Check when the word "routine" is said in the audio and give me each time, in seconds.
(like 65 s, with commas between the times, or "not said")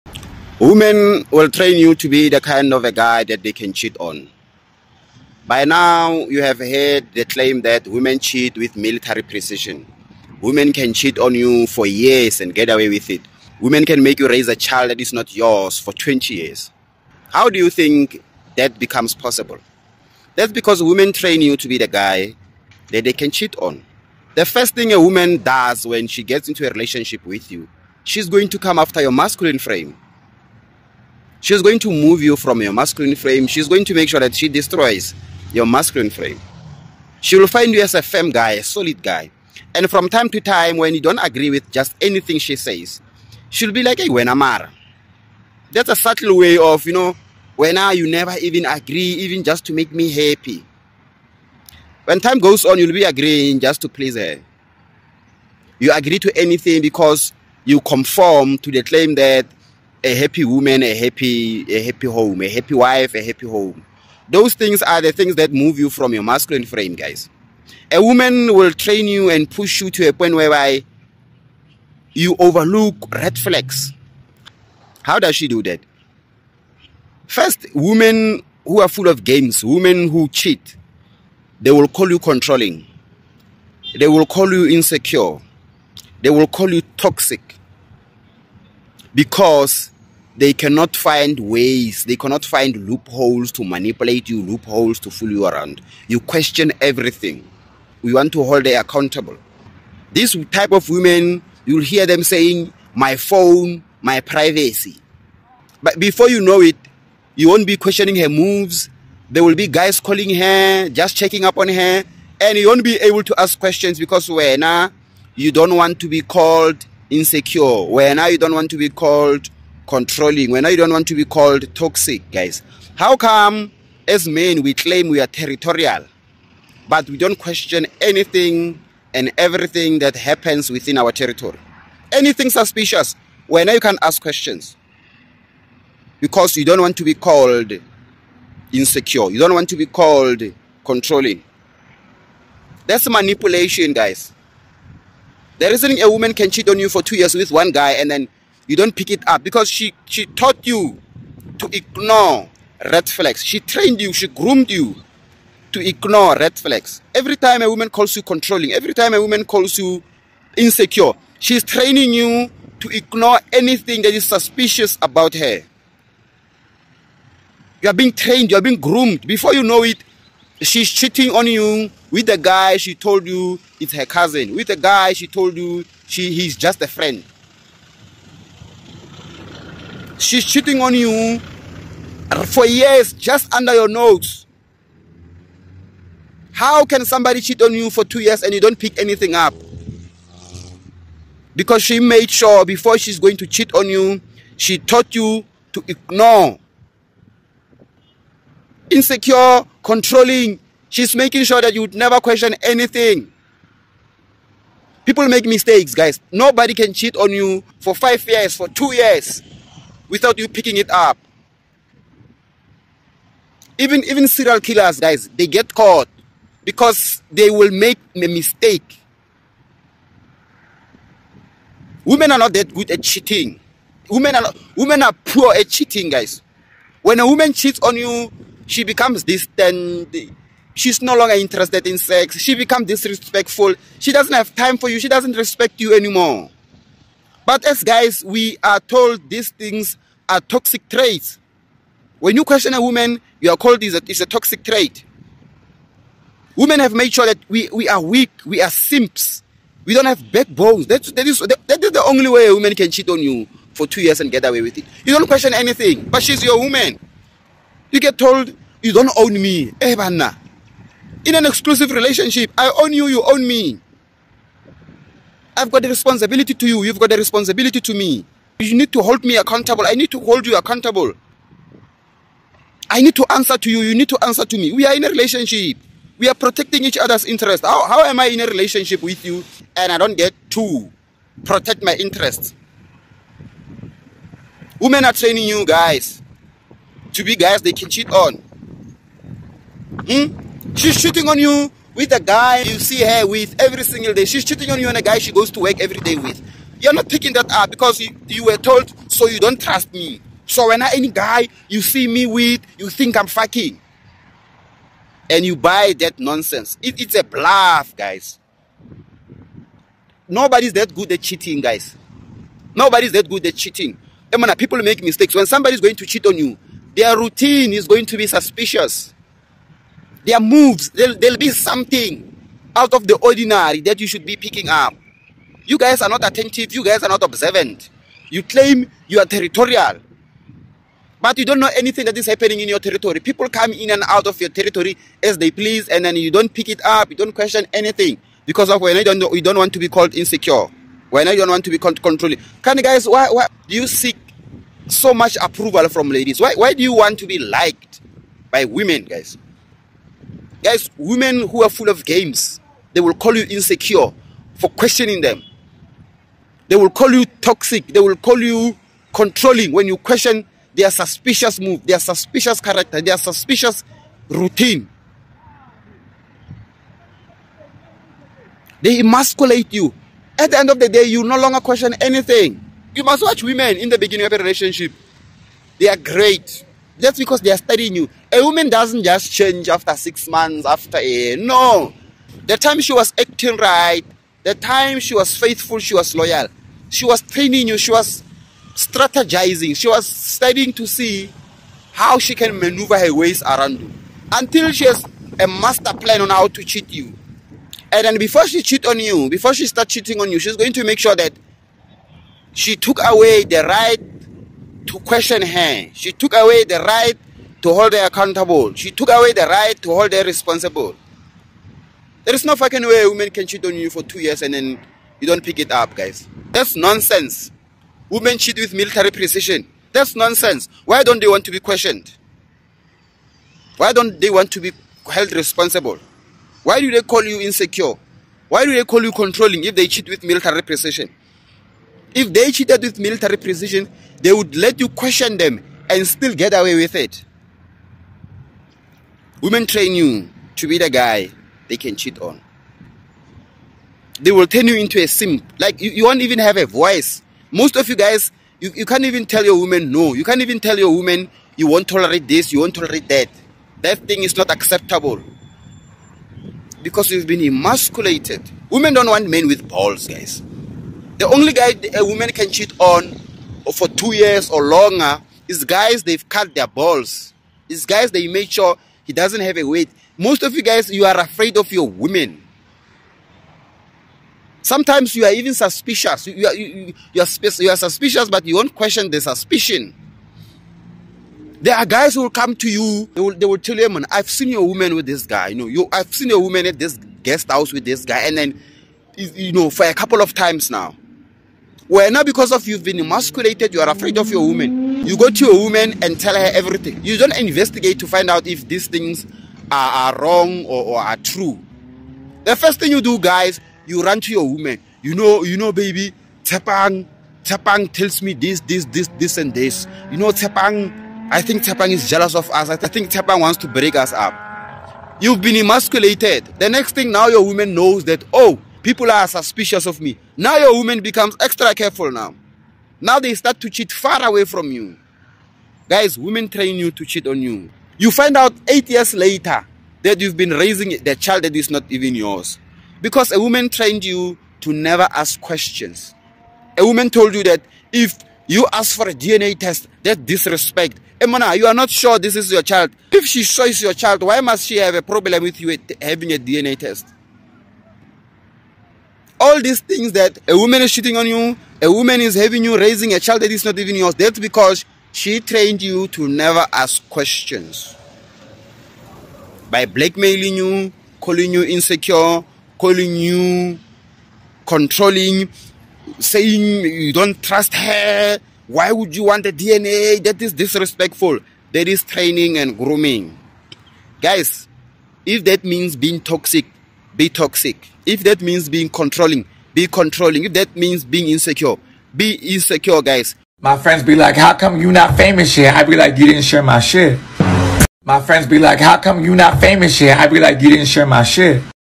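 317 s, 364 s.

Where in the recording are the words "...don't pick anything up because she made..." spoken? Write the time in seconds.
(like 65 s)
188 s.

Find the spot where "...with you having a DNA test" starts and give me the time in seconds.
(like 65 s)
545 s.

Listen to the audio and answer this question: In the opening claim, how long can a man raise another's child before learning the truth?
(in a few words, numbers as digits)
20 years.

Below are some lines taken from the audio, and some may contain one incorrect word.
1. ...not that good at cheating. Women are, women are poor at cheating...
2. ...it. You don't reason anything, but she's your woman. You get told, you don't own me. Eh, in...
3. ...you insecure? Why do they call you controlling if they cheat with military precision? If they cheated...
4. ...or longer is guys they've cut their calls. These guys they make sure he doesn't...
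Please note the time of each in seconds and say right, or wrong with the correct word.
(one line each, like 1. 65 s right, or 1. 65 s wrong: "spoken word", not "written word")
1. 222 s right
2. 254 s wrong: "question", not "reason"
3. 427 s right
4. 464 s wrong: "balls", not "calls".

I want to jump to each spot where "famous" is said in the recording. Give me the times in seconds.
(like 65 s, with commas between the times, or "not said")
585 s, 589 s.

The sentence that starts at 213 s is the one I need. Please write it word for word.
Even, even serial killers, guys, they get caught because they will make a mistake.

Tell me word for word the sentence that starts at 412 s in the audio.
There is no fucking way a woman can cheat on you for two years and then you don't pick it up, guys.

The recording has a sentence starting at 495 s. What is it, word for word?
You go to your woman and tell her everything.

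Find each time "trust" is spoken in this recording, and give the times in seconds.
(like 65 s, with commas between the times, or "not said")
299 s, 567 s.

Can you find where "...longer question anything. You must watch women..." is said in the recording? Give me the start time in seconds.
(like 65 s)
371 s.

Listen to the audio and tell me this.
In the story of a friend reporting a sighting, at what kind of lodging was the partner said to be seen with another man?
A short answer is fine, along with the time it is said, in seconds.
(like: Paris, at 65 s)
guest house, at 487 s.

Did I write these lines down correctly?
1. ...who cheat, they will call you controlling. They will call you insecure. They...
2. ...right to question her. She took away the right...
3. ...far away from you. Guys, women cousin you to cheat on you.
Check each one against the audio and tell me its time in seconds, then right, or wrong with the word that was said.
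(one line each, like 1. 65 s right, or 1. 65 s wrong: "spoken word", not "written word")
1. 80 s right
2. 403 s right
3. 523 s wrong: "train", not "cousin".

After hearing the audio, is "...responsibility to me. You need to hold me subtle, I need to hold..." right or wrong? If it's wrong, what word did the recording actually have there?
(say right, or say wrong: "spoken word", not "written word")
wrong: "accountable", not "subtle".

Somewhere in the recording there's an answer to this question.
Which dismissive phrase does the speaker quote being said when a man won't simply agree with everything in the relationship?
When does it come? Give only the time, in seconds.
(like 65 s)
44 s.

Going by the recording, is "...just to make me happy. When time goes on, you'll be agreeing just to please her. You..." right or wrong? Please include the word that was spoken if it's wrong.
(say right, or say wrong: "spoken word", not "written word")
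right.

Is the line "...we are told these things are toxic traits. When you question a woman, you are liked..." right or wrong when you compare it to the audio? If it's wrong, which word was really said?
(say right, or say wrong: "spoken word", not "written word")
wrong: "called", not "liked".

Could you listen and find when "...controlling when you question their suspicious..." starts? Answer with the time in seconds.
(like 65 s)
359 s.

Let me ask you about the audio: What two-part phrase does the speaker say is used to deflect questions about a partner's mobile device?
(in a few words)
my phone, my privacy.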